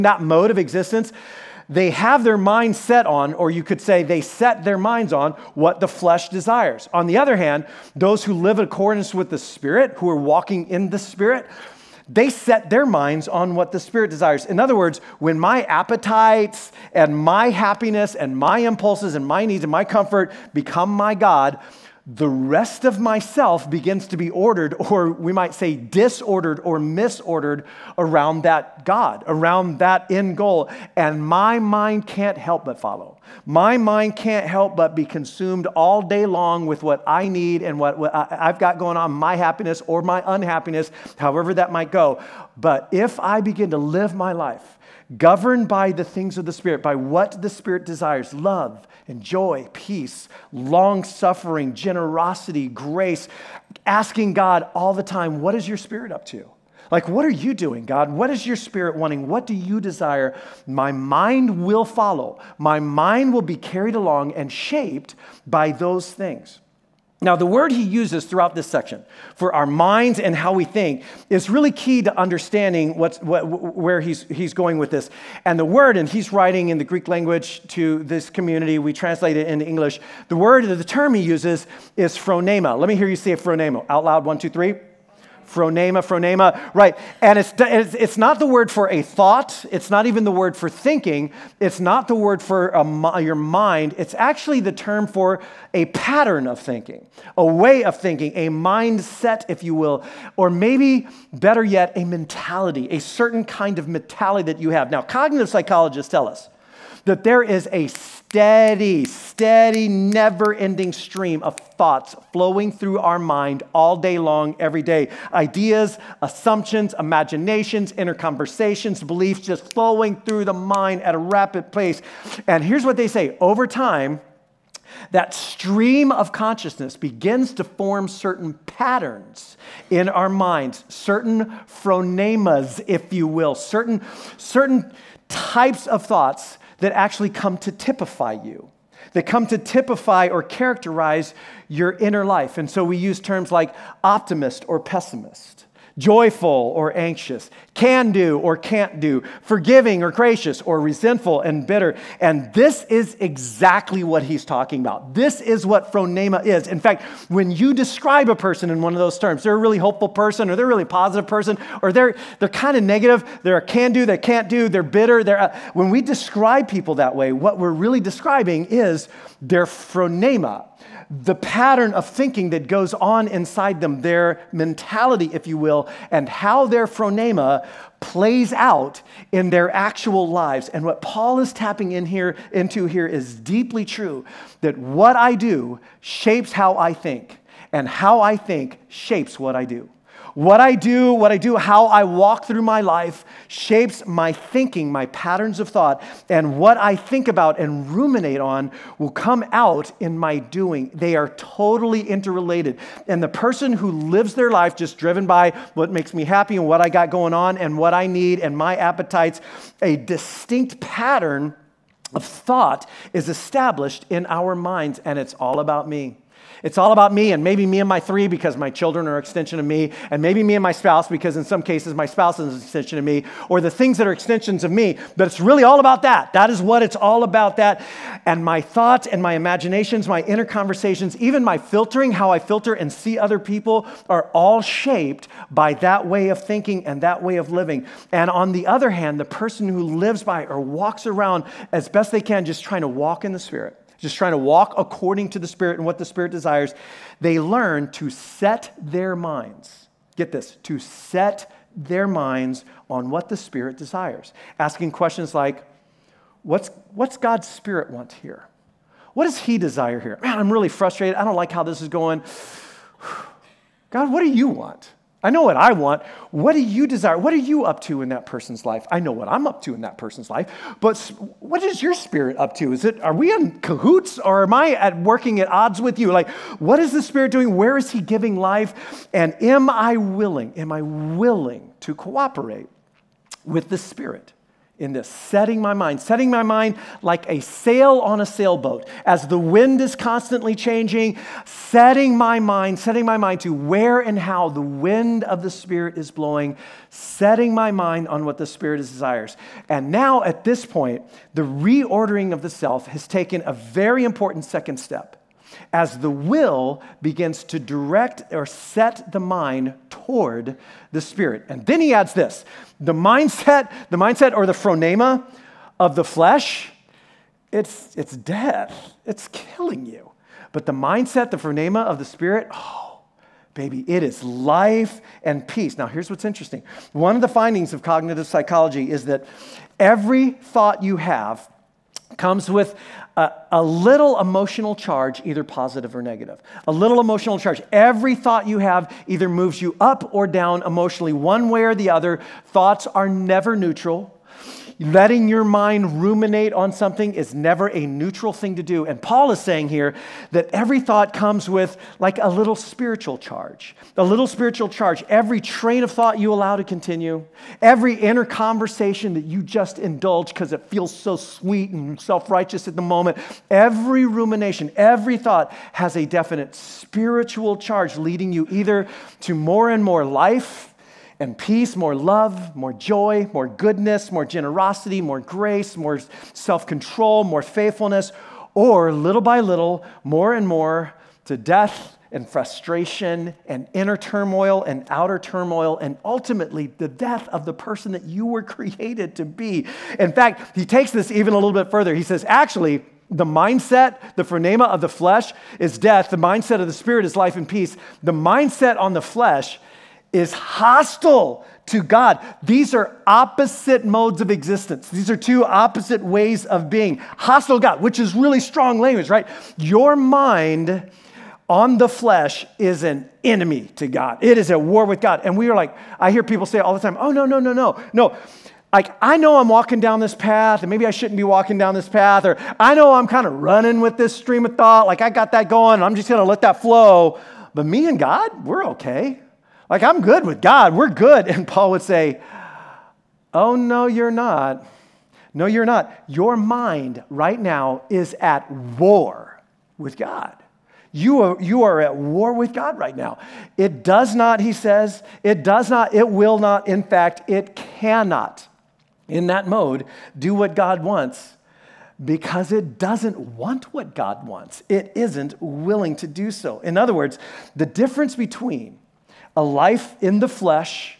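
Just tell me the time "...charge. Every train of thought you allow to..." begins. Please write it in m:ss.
5:54.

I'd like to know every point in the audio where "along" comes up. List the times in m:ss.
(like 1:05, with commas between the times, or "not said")
1:03.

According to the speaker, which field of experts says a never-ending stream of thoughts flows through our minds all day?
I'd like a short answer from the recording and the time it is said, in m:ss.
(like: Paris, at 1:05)
cognitive psychologists, at 1:45.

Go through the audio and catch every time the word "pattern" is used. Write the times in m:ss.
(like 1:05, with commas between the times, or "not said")
1:35, 2:08, 2:51, 3:15, 3:30.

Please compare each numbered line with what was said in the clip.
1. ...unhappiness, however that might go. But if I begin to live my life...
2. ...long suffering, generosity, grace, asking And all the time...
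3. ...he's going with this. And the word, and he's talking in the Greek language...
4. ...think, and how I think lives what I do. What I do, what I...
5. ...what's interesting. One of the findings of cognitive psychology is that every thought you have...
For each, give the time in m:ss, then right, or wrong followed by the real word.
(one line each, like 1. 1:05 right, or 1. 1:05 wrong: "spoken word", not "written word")
1. 0:40 right
2. 0:50 wrong: "God", not "And"
3. 1:14 wrong: "writing", not "talking"
4. 3:06 wrong: "shapes", not "lives"
5. 5:26 right.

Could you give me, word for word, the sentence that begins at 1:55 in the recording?
Ideas, assumptions, imaginations, inner conversations, beliefs just flowing through the mind at a rapid pace.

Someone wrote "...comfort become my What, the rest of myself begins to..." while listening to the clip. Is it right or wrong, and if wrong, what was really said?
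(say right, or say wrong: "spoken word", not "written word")
wrong: "God", not "What".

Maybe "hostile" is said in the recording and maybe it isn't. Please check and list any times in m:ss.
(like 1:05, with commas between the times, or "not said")
6:40, 6:47.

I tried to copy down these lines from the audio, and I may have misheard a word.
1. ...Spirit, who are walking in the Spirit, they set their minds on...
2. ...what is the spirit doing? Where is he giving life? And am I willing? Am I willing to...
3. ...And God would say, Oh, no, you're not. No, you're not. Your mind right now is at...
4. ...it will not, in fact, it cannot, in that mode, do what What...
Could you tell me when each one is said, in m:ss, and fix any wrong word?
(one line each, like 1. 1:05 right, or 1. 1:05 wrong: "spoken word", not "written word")
1. 0:09 right
2. 4:36 right
3. 7:11 wrong: "Paul", not "God"
4. 7:25 wrong: "God", not "What".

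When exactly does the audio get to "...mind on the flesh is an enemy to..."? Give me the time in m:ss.
6:49.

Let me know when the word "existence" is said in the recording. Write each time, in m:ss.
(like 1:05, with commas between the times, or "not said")
0:00, 6:44.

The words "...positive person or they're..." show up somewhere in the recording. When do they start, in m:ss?
2:40.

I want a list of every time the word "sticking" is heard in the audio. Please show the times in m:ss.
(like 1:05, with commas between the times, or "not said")
not said.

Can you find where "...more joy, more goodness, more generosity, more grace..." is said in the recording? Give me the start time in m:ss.
6:12.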